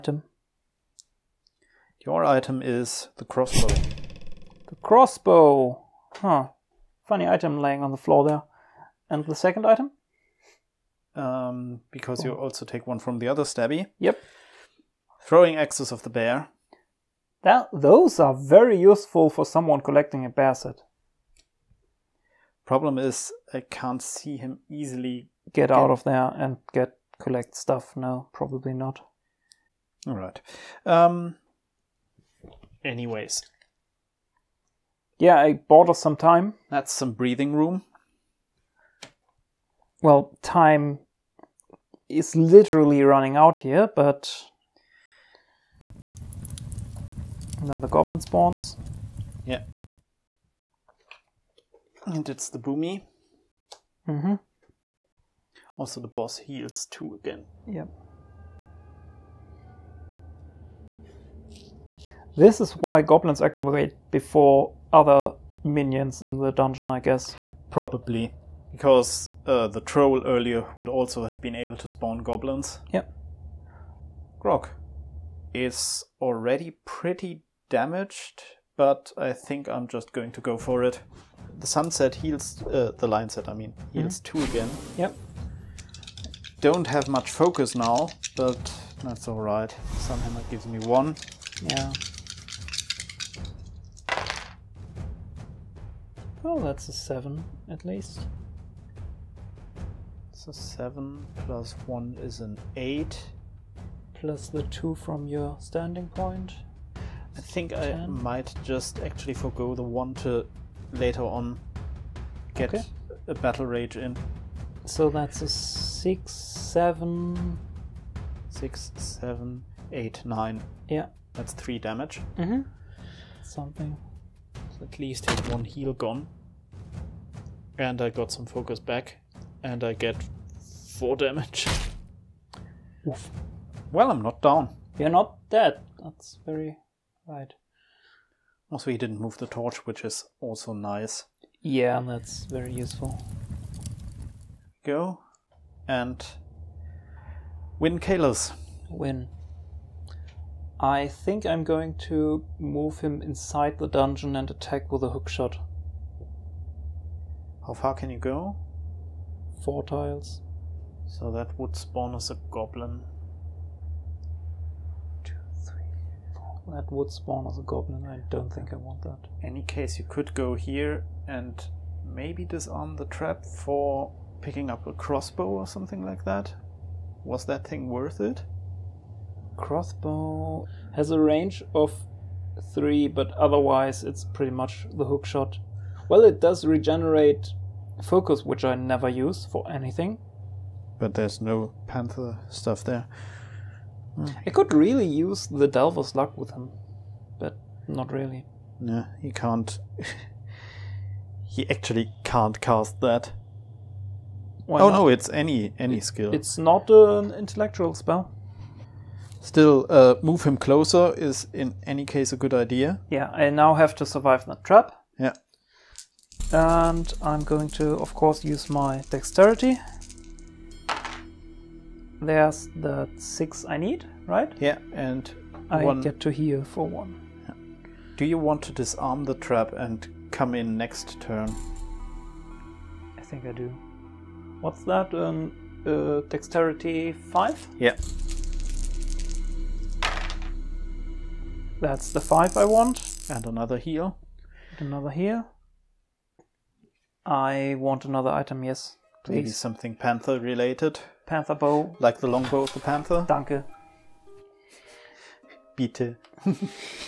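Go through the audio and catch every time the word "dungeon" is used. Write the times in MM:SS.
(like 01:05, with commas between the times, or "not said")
01:06, 02:33.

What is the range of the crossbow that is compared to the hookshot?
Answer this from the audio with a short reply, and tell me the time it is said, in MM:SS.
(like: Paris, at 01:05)
3, at 03:01.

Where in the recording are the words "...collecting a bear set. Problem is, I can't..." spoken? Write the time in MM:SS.
00:19.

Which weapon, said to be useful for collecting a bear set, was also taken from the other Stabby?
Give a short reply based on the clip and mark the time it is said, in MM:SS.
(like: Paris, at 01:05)
Throwing axes of the bear, at 00:15.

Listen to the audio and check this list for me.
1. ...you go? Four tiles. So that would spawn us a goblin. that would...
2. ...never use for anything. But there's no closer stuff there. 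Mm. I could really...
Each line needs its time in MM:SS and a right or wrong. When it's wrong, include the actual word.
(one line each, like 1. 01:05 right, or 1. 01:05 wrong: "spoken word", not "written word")
1. 02:38 right
2. 03:08 wrong: "panther", not "closer".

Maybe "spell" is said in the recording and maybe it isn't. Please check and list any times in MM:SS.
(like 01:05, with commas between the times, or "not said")
03:27.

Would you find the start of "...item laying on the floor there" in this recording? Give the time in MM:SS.
00:07.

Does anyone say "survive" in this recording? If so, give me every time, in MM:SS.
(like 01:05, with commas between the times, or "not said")
03:34.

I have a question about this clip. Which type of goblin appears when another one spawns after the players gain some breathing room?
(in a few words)
Boomy.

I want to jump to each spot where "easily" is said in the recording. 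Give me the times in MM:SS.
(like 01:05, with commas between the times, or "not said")
00:24.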